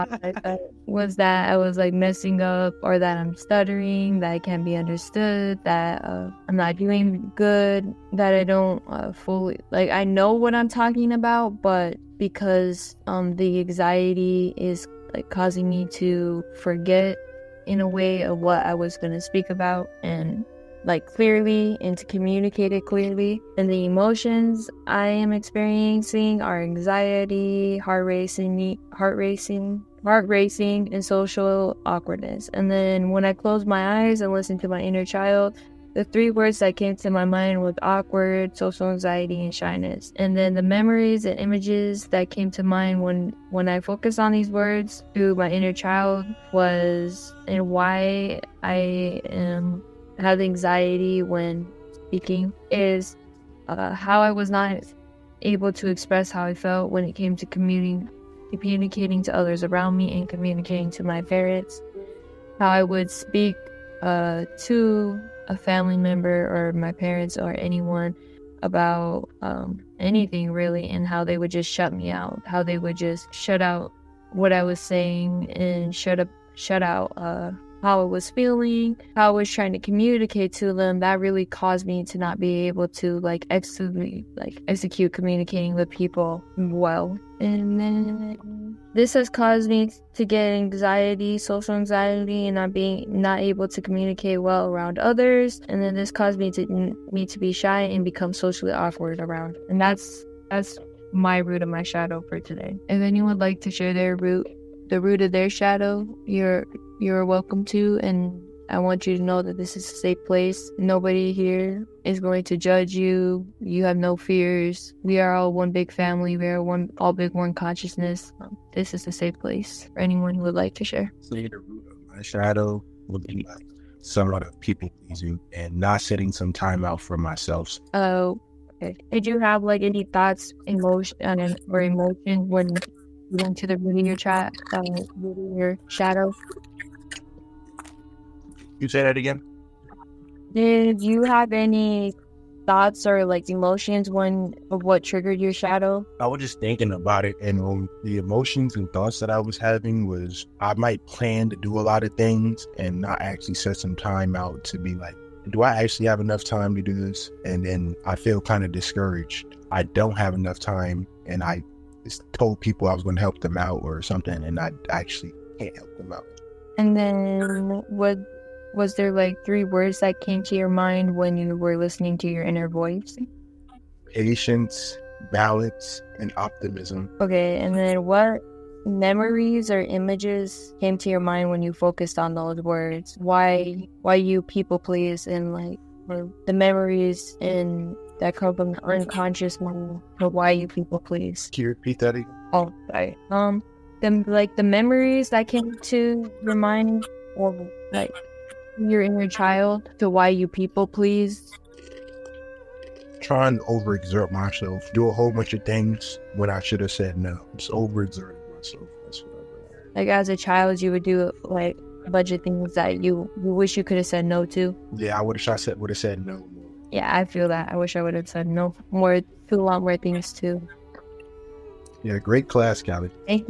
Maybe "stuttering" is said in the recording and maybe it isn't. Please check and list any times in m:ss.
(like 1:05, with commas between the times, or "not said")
0:03.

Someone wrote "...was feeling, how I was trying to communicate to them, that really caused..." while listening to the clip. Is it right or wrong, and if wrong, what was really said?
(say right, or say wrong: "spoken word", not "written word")
right.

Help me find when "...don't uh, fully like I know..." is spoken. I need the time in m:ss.
0:08.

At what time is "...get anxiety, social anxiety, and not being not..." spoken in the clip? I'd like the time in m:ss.
1:30.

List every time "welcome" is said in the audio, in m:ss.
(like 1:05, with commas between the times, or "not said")
1:47.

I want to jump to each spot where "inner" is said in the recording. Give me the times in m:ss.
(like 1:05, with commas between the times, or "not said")
0:34, 0:45, 2:52, 3:19.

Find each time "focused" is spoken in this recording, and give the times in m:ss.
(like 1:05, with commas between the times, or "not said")
0:43, 3:01.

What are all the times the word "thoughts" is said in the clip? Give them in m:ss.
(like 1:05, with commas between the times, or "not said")
2:10, 2:22, 2:28.